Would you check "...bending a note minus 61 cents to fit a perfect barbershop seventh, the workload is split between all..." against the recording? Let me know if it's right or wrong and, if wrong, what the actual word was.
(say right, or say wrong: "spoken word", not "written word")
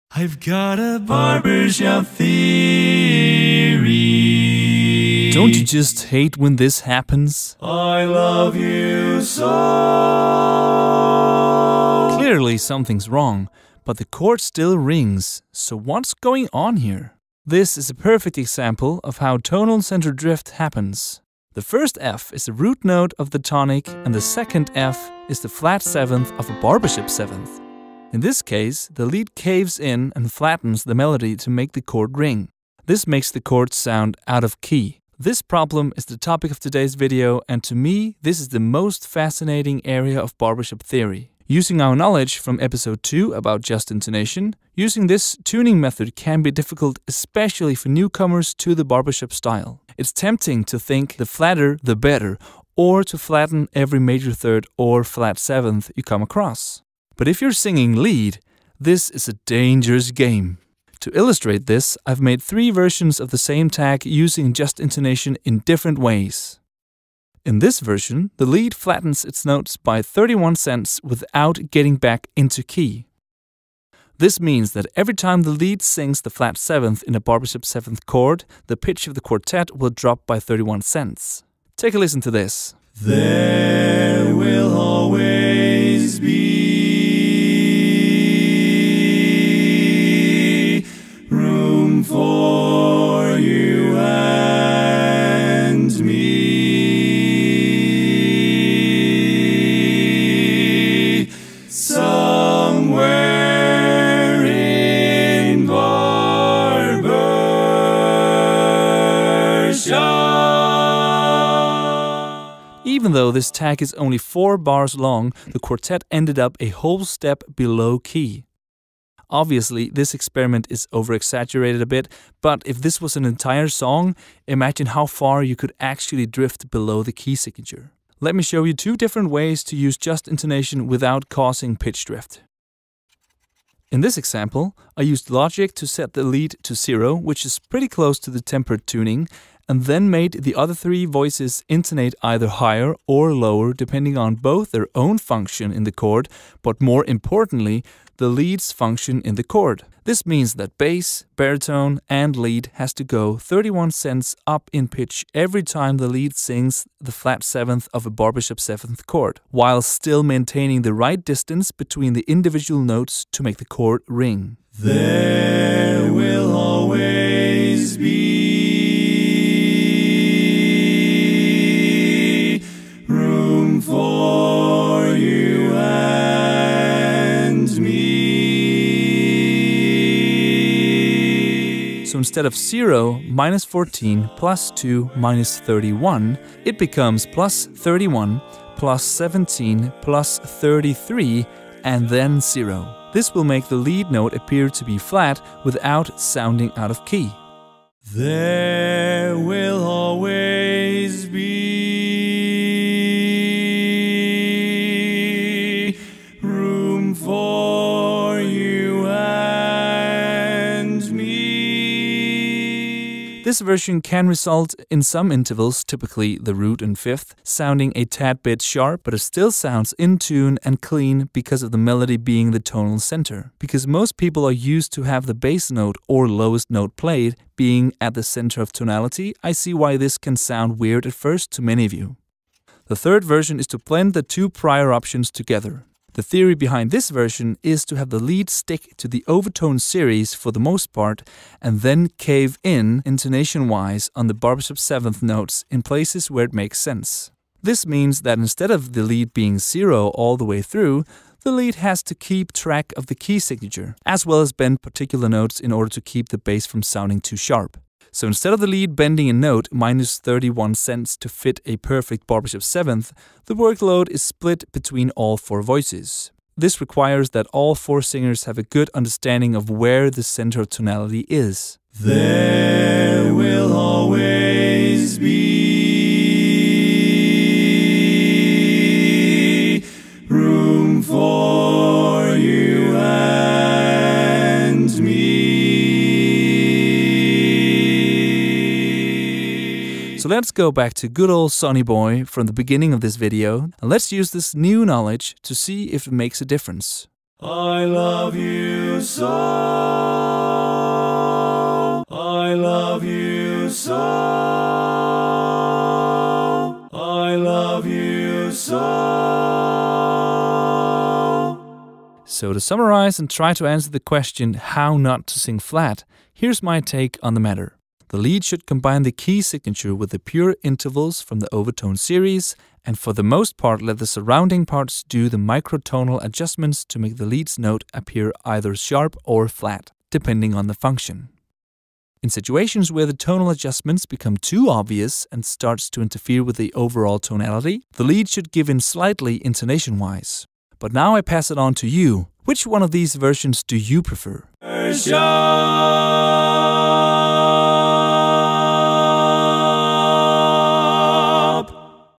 wrong: "31", not "61".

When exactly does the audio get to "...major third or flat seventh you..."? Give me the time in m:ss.
0:54.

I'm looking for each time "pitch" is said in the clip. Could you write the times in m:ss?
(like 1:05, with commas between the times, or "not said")
1:18, 2:11, 2:34.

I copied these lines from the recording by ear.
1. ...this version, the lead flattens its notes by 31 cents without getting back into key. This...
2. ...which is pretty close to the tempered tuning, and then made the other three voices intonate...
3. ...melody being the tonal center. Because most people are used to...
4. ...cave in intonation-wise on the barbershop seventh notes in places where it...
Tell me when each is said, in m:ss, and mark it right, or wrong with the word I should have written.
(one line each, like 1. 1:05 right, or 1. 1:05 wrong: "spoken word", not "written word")
1. 1:07 right
2. 2:17 right
3. 3:41 right
4. 4:02 right.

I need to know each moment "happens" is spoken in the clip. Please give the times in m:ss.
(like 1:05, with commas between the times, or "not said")
0:06, 0:20.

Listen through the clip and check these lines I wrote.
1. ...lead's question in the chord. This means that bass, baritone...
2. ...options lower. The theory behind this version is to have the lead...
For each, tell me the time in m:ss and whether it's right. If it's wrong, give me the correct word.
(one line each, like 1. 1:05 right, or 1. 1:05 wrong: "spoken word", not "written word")
1. 2:28 wrong: "function", not "question"
2. 3:54 wrong: "together", not "lower".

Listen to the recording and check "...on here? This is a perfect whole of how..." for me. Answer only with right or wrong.
wrong.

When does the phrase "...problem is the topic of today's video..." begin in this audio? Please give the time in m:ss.
0:35.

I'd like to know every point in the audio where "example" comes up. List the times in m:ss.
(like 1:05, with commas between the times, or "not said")
0:18, 2:14.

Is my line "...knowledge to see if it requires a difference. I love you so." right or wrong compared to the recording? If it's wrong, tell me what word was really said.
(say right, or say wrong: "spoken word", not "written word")
wrong: "makes", not "requires".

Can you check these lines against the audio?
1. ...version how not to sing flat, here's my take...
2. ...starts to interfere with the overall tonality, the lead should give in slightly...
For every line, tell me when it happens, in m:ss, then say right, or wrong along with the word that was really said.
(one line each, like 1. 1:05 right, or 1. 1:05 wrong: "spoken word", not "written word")
1. 5:13 wrong: "question", not "version"
2. 5:35 right.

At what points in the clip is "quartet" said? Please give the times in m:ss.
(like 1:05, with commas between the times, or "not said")
1:19, 1:55.